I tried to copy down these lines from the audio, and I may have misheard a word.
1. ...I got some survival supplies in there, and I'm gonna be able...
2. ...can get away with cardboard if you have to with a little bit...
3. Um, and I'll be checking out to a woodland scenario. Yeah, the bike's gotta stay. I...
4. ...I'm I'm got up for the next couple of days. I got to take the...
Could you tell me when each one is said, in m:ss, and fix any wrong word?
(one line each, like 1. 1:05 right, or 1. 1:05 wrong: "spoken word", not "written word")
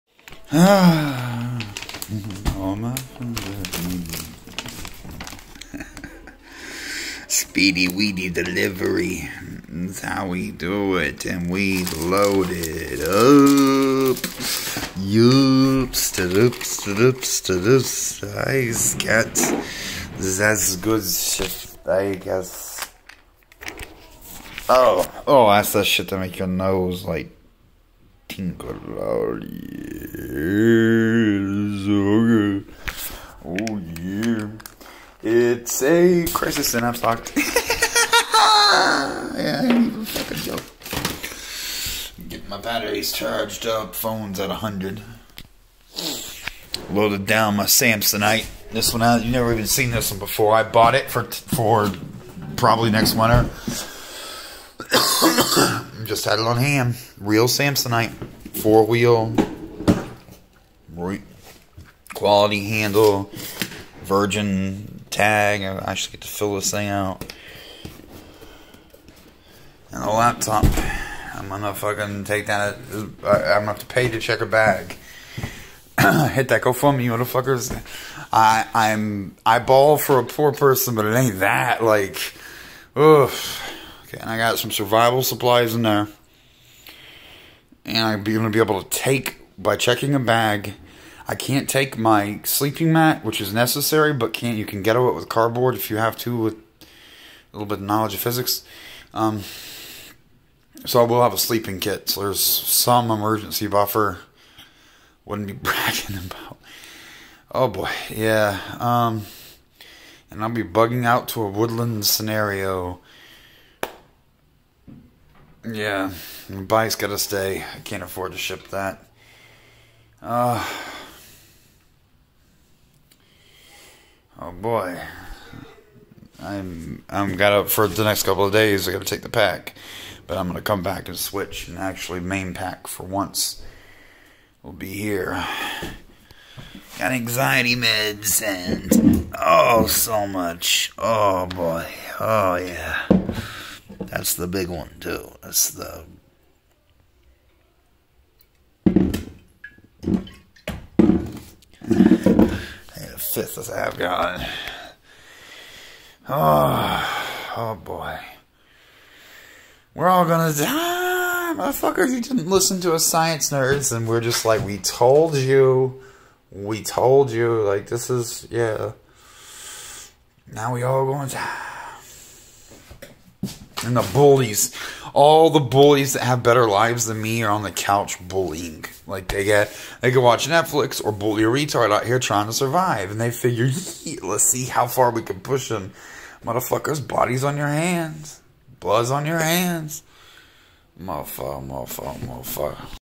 1. 1:24 right
2. 1:34 right
3. 1:48 wrong: "bugging", not "checking"
4. 2:06 right.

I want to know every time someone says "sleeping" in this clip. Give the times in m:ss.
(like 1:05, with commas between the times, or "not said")
1:32, 1:41.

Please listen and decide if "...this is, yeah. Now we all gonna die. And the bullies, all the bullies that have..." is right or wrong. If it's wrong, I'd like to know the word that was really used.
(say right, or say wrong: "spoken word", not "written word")
right.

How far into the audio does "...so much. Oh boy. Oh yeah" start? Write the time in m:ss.
2:19.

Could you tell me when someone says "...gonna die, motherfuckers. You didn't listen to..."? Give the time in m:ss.
2:40.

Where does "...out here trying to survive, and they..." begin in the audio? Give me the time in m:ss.
3:01.